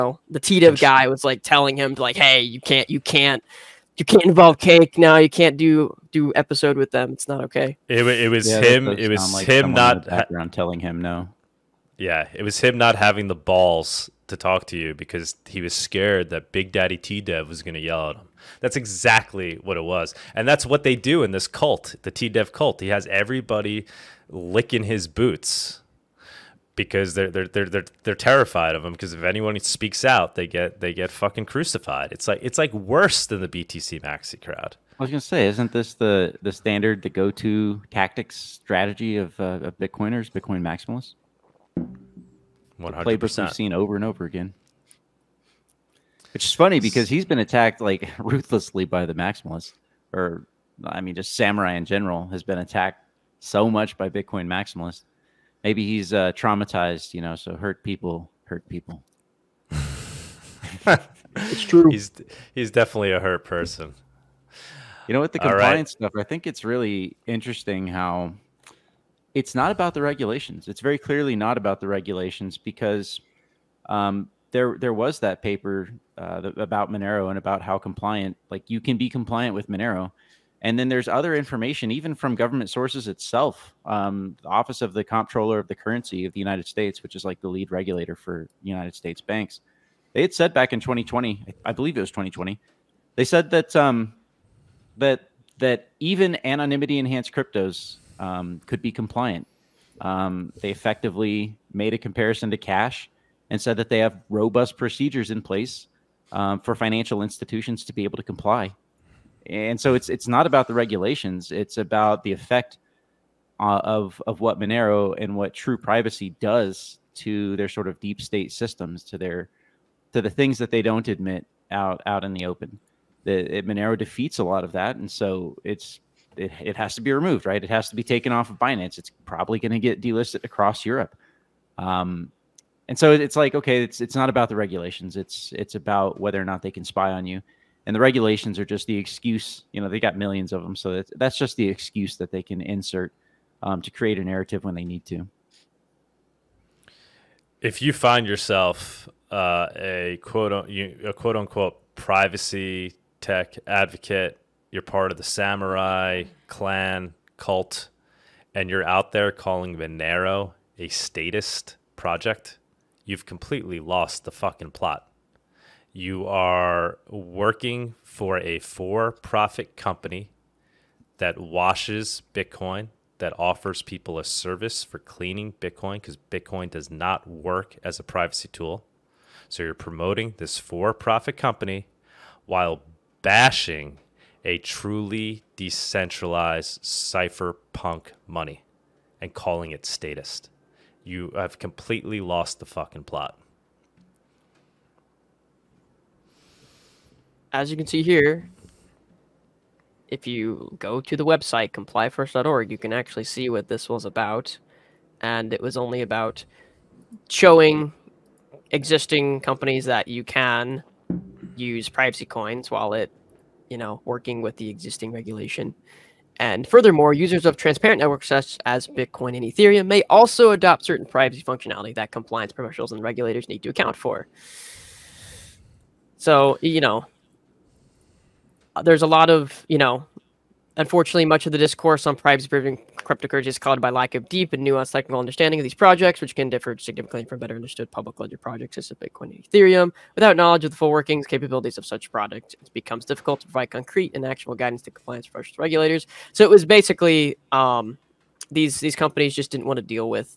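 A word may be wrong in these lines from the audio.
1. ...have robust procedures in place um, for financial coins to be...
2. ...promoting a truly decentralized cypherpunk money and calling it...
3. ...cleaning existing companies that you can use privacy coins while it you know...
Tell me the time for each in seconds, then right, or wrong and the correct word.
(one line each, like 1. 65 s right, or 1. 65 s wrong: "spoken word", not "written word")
1. 103 s wrong: "institutions", not "coins"
2. 183 s wrong: "bashing", not "promoting"
3. 207 s wrong: "showing", not "cleaning".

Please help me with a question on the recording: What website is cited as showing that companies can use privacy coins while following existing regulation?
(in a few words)
complyfirst.org.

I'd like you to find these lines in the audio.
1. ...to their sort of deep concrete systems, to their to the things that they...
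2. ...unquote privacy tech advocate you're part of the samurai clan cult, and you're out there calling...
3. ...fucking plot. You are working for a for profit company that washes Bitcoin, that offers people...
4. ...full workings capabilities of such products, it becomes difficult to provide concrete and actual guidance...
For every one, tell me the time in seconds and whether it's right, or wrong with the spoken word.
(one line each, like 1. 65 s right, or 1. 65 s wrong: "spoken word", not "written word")
1. 117 s wrong: "state", not "concrete"
2. 151 s right
3. 164 s right
4. 240 s right.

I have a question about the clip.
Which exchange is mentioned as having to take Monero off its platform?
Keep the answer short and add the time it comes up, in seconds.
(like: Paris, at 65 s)
Binance, at 128 s.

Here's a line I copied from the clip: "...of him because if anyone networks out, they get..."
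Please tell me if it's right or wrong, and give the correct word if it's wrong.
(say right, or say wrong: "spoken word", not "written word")
wrong: "speaks", not "networks".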